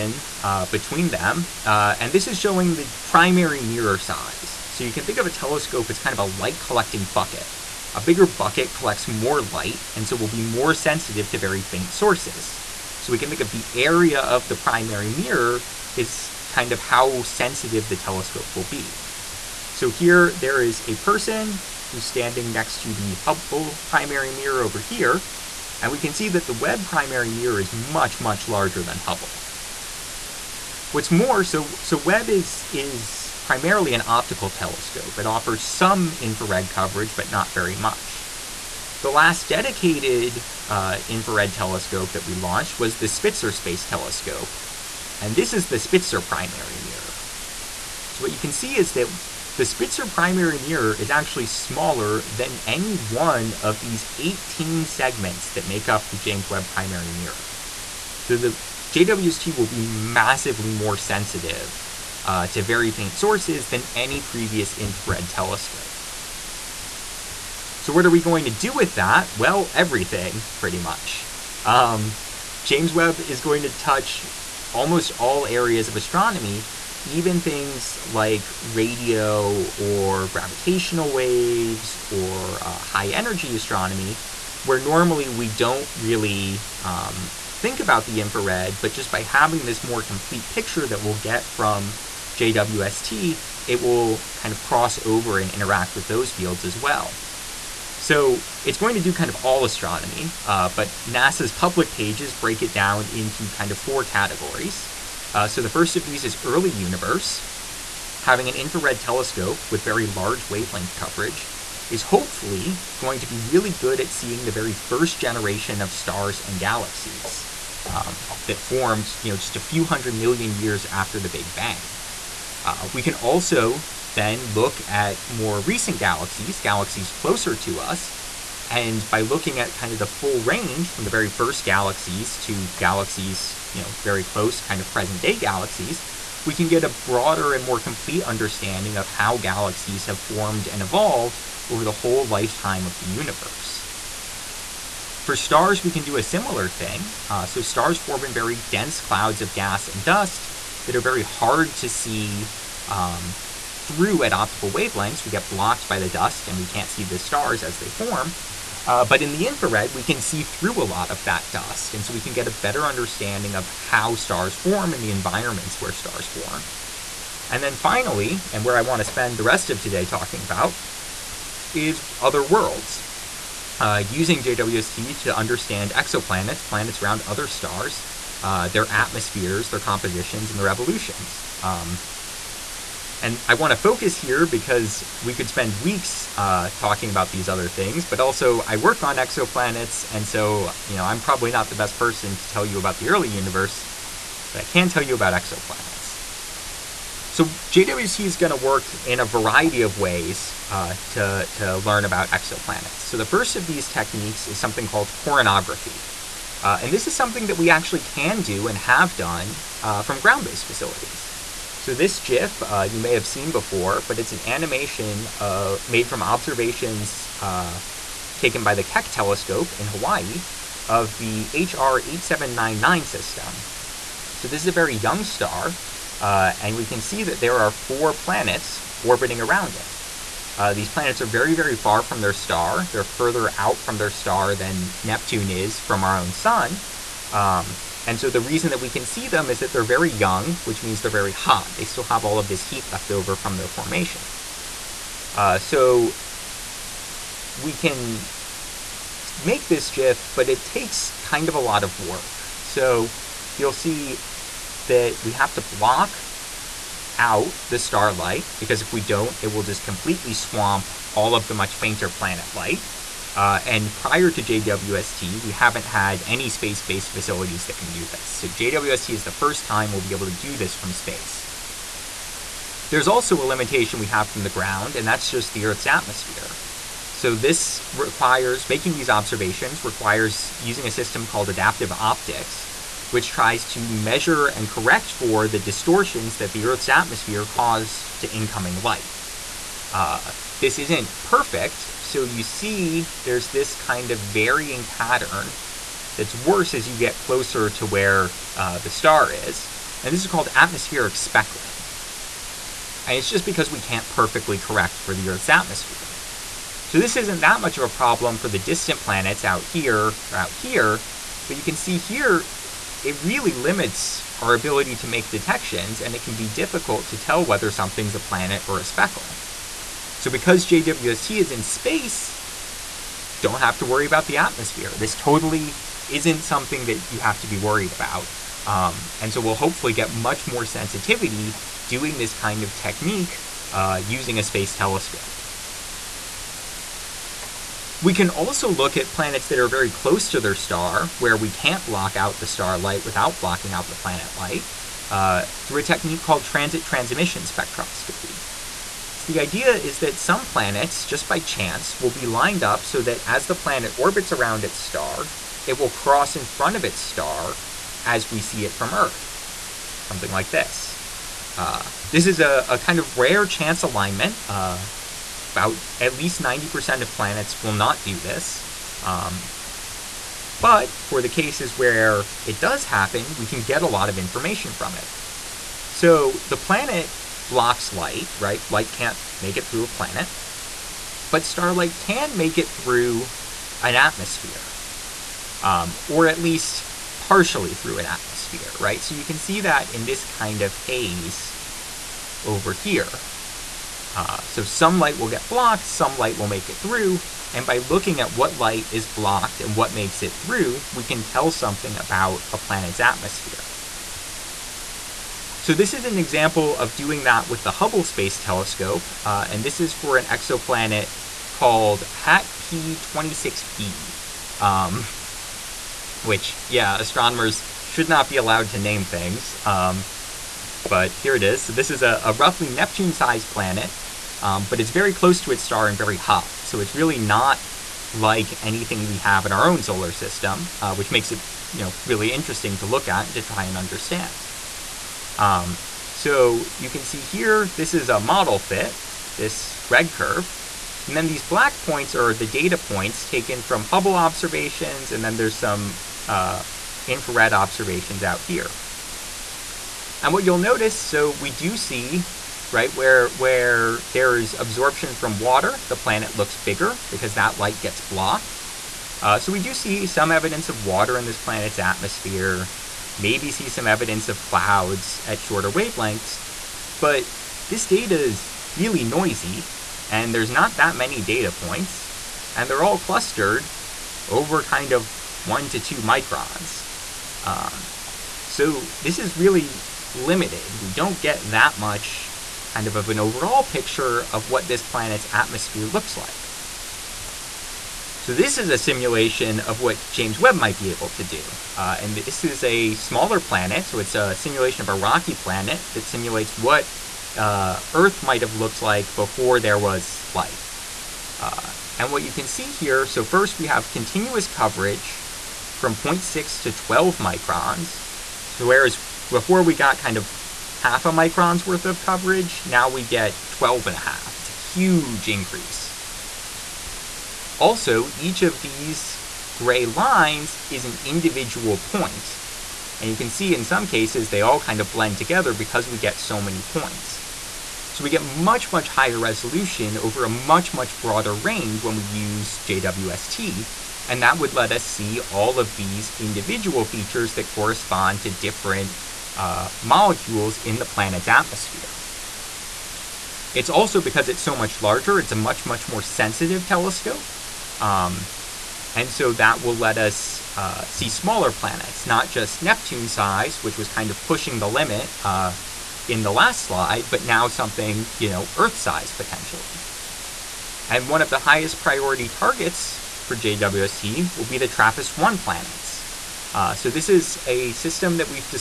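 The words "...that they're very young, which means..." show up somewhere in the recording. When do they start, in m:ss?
3:59.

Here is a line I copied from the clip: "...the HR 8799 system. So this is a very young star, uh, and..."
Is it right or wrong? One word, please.
right.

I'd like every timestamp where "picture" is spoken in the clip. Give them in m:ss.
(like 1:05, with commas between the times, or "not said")
1:30, 8:03.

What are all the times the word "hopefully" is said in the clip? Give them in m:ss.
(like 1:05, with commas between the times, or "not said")
1:52, 5:29.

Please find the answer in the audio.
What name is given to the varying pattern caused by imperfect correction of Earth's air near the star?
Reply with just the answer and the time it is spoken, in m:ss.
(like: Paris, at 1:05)
atmospheric speckling, at 5:00.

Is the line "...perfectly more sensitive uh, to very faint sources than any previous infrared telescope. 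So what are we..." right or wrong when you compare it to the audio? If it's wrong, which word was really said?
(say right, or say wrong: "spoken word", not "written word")
wrong: "massively", not "perfectly".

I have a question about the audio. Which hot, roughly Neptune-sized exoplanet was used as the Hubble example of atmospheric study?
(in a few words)
HAT P26b.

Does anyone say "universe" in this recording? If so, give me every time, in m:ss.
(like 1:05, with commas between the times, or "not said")
1:46, 2:23, 3:13.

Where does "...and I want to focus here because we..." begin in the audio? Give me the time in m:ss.
3:03.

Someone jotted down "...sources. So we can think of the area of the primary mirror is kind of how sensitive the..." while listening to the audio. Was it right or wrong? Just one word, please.
right.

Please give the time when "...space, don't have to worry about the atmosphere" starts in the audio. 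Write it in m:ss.
5:21.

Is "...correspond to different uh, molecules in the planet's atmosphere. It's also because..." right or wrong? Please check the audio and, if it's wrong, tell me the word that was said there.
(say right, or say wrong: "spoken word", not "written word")
right.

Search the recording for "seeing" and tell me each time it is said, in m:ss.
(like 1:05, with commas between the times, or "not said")
1:54.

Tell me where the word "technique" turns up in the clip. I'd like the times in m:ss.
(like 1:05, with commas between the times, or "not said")
3:23, 5:32, 5:45.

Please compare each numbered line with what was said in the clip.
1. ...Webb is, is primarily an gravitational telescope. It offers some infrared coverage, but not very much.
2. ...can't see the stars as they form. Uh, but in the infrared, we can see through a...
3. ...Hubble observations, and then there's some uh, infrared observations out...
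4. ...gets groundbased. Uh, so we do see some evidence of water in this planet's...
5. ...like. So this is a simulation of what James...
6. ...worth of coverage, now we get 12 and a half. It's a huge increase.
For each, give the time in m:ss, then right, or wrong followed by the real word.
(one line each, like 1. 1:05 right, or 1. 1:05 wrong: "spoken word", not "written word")
1. 0:31 wrong: "optical", not "gravitational"
2. 2:36 right
3. 7:23 right
4. 7:37 wrong: "blocked", not "groundbased"
5. 8:06 right
6. 8:31 right.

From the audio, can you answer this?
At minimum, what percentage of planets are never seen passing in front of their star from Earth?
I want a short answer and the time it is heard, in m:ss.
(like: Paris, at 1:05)
90%, at 6:06.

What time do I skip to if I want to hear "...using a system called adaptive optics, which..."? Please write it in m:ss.
4:40.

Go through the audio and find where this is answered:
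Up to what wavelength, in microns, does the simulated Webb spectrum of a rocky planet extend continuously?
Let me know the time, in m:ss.
8:26.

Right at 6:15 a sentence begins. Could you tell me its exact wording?
So the planet blocks light, right?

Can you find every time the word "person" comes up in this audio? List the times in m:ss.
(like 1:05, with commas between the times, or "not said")
0:20, 3:11.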